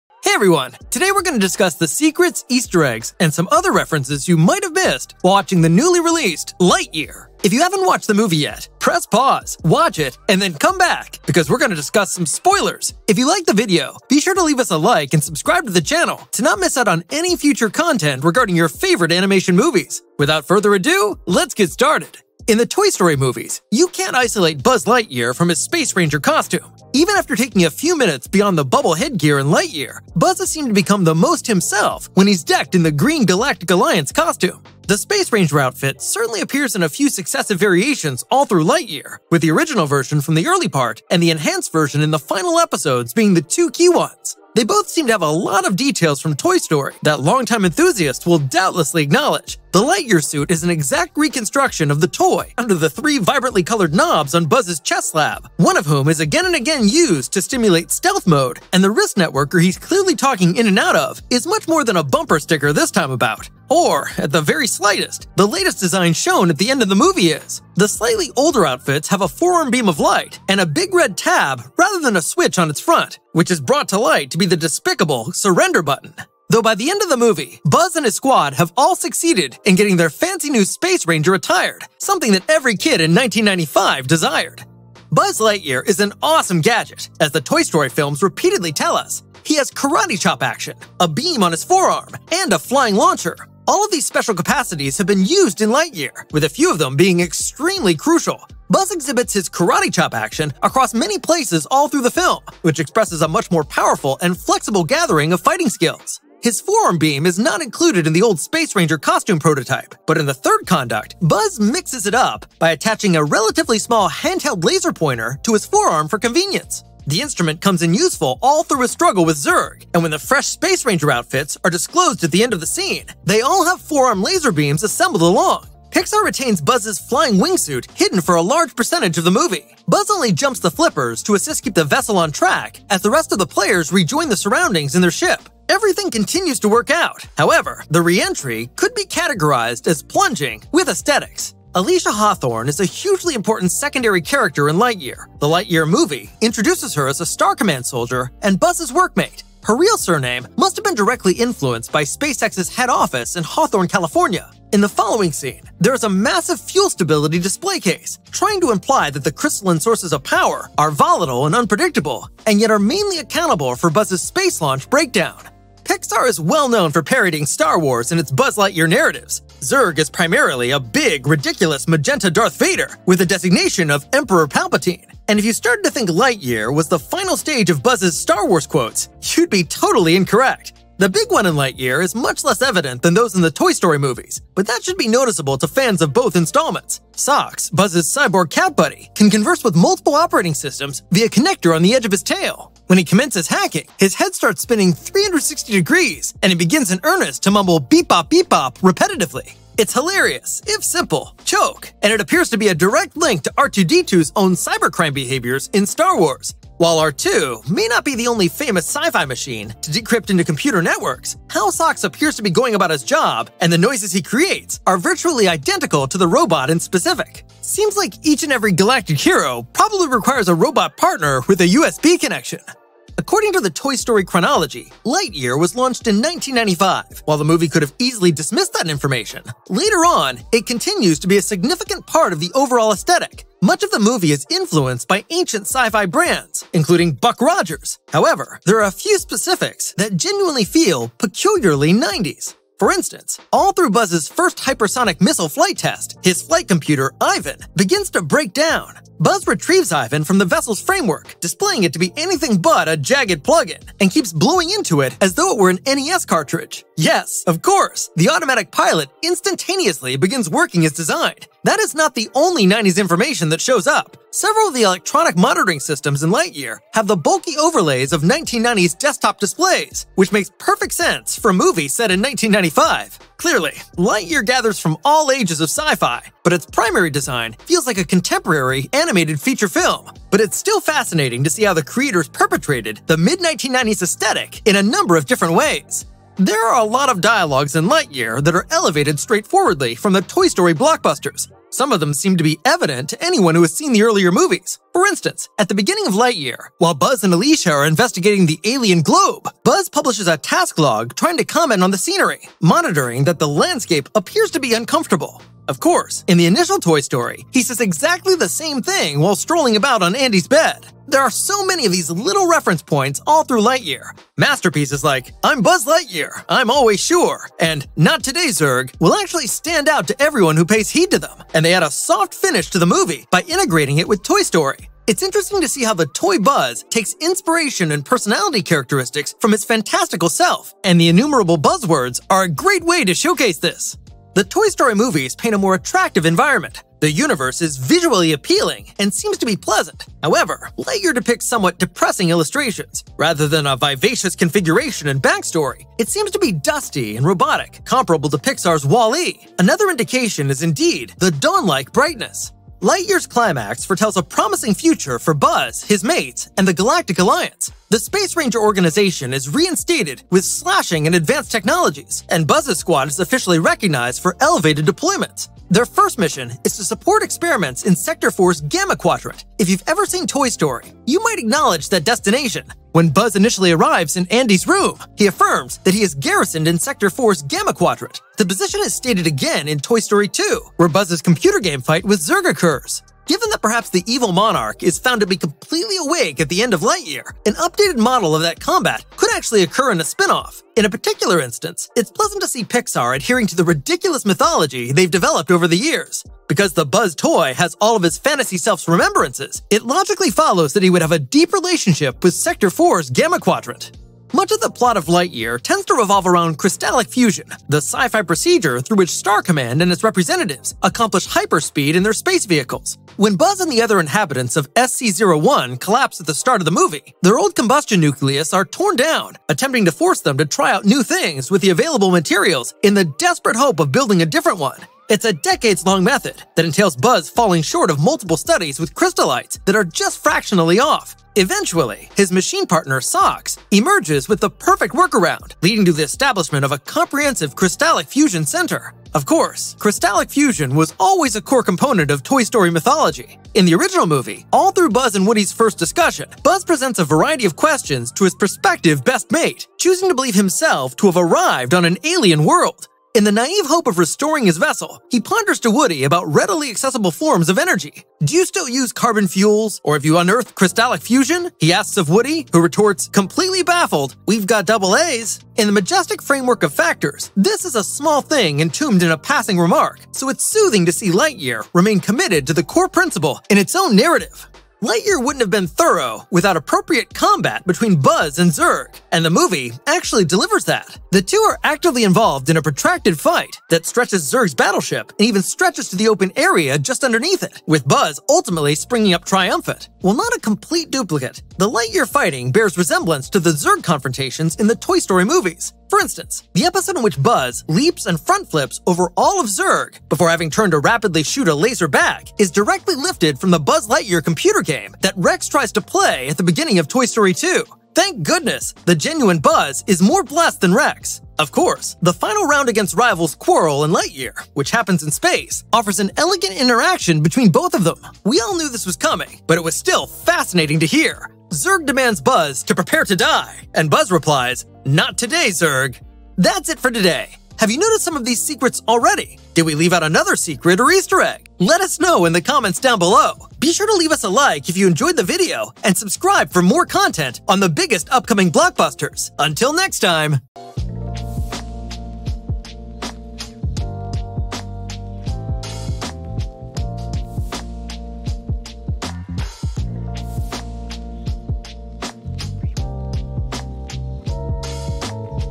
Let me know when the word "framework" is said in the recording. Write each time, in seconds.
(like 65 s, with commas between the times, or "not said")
250 s, 466 s.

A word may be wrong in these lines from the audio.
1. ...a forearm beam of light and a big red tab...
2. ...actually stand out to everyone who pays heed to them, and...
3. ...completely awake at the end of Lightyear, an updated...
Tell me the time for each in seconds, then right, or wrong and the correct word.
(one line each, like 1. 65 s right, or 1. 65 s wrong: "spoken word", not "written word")
1. 69 s right
2. 319 s right
3. 385 s right.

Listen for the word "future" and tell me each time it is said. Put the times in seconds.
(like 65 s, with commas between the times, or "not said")
17 s, 354 s.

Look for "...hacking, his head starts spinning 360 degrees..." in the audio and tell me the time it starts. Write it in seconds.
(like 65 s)
193 s.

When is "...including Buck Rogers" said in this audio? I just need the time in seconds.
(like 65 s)
236 s.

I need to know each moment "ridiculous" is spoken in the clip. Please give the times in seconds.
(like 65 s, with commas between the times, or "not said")
171 s, 393 s.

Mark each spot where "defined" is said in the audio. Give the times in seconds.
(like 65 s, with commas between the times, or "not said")
not said.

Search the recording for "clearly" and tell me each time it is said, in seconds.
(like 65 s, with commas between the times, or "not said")
59 s, 273 s.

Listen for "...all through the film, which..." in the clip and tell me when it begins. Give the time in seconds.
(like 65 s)
101 s.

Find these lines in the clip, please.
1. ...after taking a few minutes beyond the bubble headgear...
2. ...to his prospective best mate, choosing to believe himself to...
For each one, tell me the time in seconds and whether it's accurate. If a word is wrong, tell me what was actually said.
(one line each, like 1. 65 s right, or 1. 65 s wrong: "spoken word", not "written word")
1. 27 s right
2. 448 s right.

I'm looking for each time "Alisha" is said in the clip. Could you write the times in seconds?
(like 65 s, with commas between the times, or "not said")
141 s, 297 s.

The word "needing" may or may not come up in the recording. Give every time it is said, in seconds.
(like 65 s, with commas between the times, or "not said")
not said.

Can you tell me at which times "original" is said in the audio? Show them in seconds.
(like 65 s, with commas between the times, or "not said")
39 s, 443 s.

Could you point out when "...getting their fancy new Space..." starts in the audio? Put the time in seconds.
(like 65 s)
79 s.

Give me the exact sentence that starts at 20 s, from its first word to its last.
Without further ado, let's get started!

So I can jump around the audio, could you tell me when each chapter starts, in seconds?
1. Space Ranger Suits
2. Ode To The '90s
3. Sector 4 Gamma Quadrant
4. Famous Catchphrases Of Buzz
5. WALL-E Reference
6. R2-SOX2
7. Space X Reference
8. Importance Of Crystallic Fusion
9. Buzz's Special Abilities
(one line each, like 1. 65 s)
1. 25 s
2. 226 s
3. 355 s
4. 289 s
5. 337 s
6. 168 s
7. 144 s
8. 407 s
9. 88 s.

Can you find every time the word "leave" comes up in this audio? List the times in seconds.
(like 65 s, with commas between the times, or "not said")
14 s, 529 s, 533 s.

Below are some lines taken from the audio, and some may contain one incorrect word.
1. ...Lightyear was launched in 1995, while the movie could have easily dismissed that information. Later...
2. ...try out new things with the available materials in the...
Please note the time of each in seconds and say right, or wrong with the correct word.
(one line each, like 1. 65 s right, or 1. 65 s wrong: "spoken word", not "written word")
1. 225 s right
2. 420 s right.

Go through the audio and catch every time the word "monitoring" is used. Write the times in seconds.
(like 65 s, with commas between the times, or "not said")
265 s, 302 s.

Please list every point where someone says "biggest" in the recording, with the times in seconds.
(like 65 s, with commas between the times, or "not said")
537 s.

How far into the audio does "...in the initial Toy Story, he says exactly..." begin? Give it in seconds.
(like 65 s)
306 s.